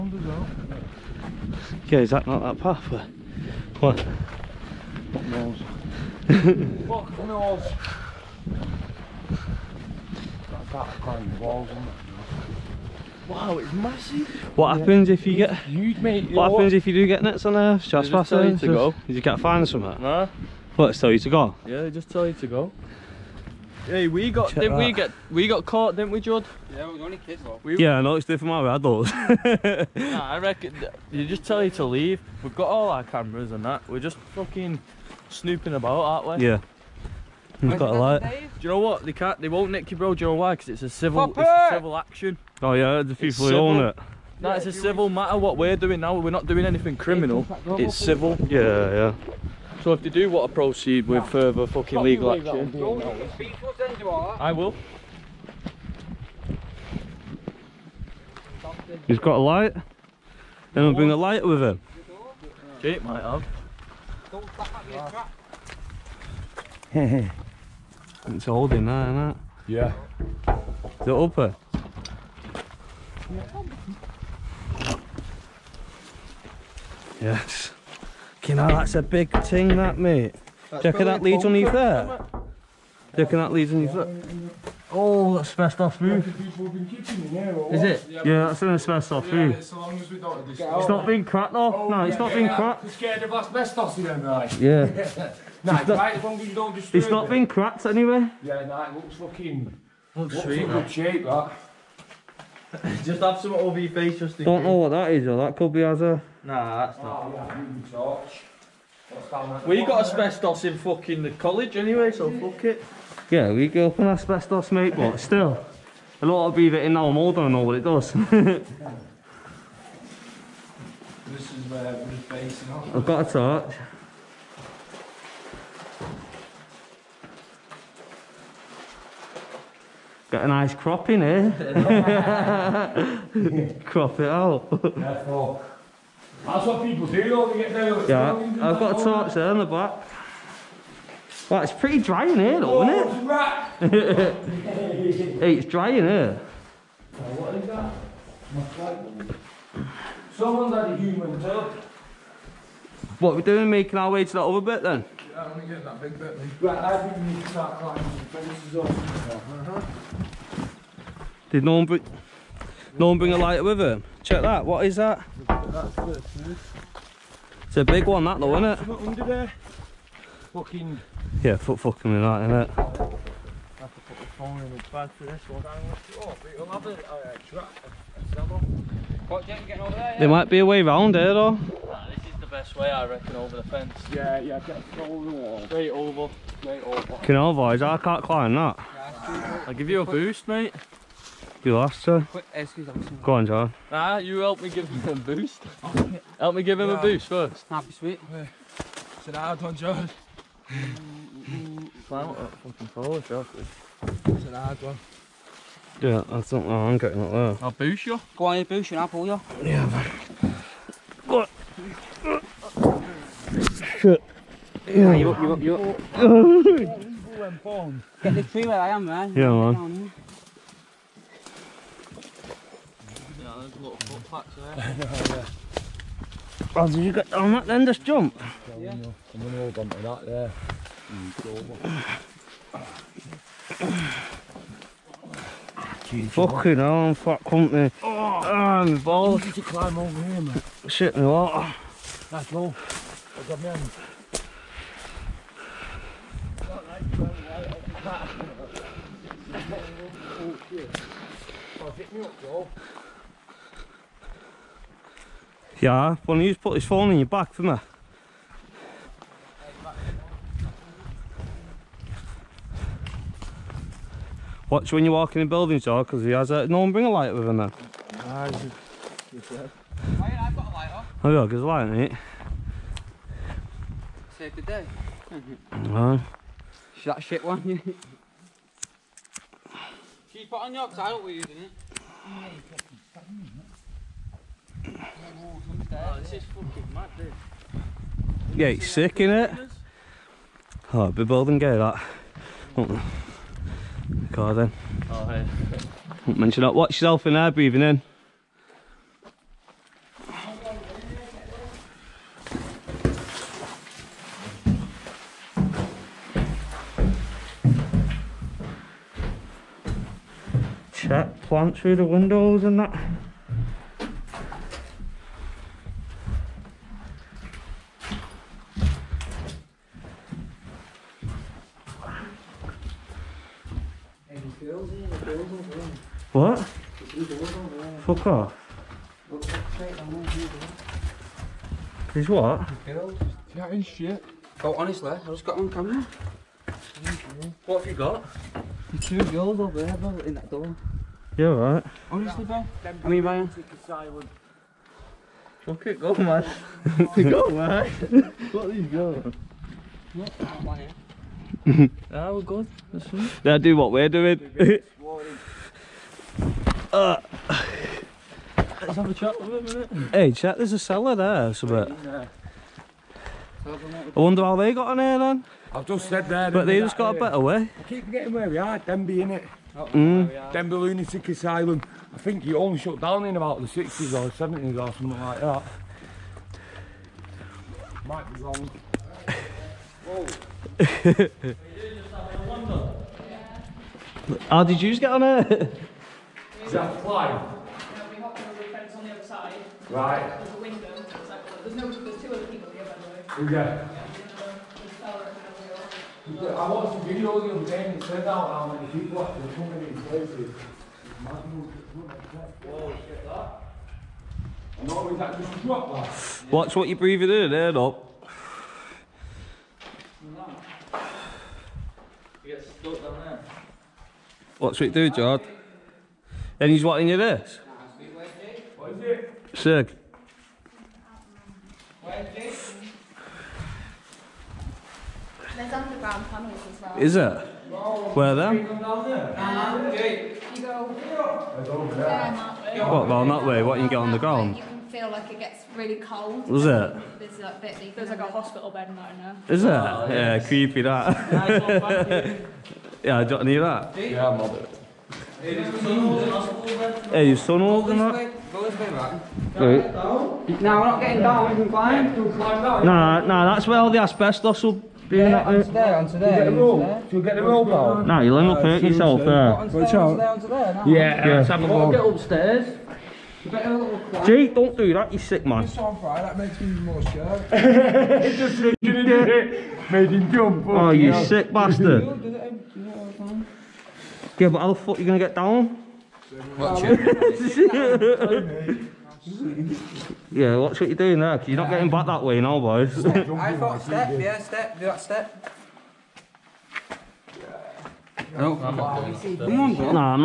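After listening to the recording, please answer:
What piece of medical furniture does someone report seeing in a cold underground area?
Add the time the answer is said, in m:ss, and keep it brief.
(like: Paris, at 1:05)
hospital bed, at 7:18.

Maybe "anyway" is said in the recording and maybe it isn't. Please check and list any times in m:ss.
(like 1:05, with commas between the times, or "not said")
1:37, 1:51.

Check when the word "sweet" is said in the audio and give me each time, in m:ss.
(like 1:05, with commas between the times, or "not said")
1:40, 3:17.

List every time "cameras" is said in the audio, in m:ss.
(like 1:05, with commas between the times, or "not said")
0:33, 5:35.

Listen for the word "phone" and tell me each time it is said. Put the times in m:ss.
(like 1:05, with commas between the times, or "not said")
2:54, 4:16.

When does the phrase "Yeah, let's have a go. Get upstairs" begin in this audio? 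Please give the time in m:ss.
7:40.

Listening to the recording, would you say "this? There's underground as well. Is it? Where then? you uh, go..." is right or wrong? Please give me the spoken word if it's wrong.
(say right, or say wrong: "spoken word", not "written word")
right.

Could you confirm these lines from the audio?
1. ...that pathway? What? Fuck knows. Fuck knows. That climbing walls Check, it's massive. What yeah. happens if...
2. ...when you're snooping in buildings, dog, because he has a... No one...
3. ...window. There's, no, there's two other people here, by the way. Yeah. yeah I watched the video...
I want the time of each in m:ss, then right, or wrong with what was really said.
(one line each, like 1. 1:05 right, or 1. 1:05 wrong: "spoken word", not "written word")
1. 0:02 wrong: "Wow", not "Check"
2. 4:24 wrong: "walking", not "snooping"
3. 6:30 right.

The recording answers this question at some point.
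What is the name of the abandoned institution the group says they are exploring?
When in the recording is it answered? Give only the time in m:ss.
6:10.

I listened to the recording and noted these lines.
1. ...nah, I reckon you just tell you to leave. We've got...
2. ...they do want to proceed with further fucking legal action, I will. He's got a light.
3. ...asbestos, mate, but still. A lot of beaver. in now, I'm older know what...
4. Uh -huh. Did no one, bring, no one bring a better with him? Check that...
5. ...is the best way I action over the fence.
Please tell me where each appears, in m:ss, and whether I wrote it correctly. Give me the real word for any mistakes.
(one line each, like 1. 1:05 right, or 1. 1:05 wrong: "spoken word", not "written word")
1. 0:29 right
2. 0:50 right
3. 1:54 right
4. 2:38 wrong: "lighter", not "better"
5. 3:02 wrong: "reckon", not "action".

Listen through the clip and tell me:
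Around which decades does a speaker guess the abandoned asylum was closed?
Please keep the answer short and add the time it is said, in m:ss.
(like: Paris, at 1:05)
60s or 70s, at 6:13.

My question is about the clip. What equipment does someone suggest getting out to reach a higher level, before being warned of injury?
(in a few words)
rope.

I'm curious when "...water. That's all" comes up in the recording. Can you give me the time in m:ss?
4:01.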